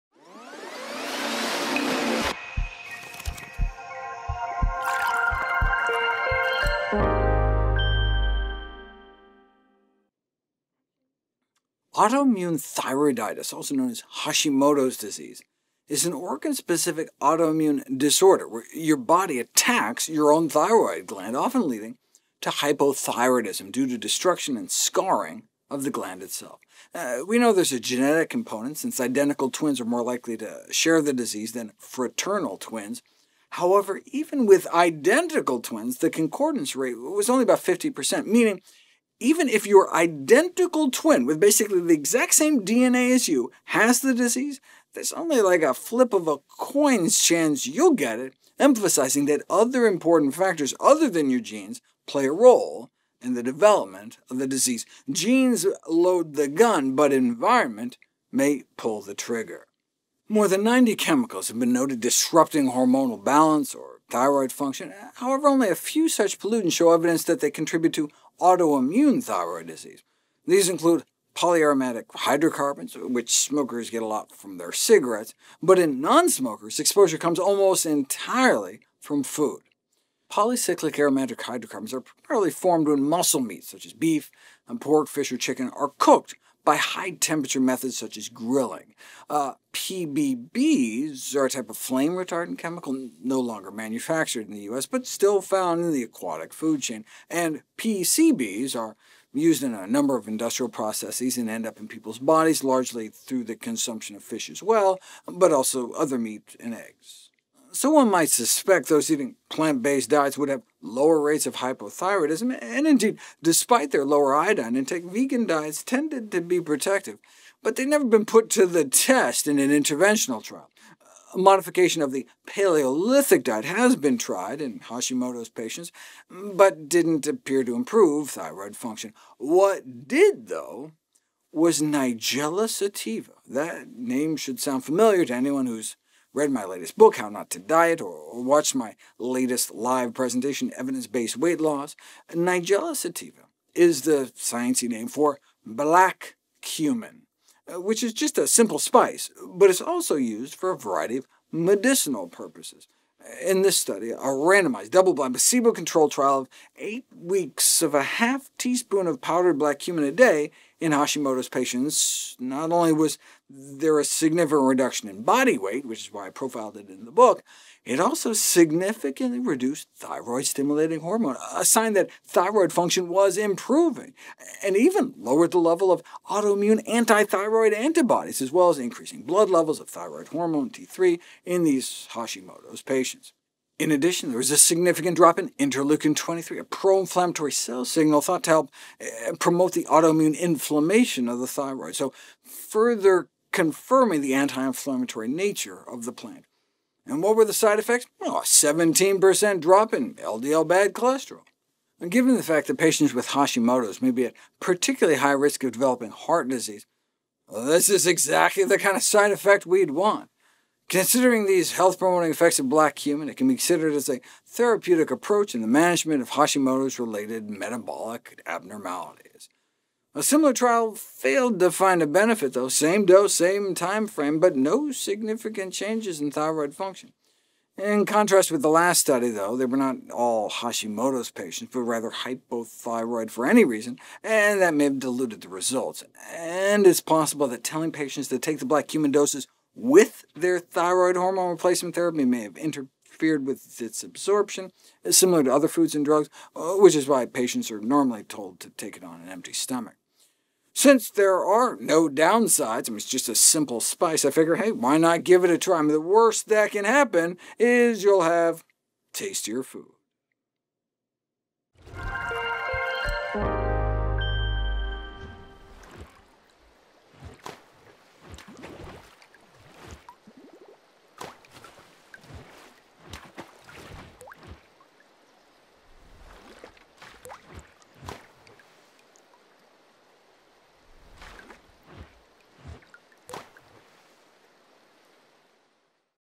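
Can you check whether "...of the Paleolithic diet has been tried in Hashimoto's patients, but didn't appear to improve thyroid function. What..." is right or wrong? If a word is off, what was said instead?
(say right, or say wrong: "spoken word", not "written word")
right.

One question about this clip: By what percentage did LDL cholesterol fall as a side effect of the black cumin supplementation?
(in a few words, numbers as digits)
17%.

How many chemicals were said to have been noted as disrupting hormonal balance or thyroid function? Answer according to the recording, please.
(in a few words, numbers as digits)
More than 90.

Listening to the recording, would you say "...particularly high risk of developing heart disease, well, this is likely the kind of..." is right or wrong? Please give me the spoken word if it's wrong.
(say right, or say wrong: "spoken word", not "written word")
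wrong: "exactly", not "likely".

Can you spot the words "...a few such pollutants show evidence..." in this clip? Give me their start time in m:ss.
1:05.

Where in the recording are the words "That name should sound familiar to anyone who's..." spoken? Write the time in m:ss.
2:13.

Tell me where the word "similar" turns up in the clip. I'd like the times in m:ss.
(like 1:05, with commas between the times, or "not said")
3:40, 4:05.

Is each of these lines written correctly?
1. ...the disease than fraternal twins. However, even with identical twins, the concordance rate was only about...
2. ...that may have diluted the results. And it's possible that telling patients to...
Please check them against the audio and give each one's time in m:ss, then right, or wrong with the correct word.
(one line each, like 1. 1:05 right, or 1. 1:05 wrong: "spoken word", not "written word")
1. 0:31 right
2. 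3:54 right.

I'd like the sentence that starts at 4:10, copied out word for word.
Since there are no downsides, I mean, it's just a simple spice, I figure, hey, why not give it a try?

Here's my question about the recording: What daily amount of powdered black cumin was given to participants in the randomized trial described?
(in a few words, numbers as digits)
half teaspoon.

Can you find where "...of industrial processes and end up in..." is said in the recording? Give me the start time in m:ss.
1:40.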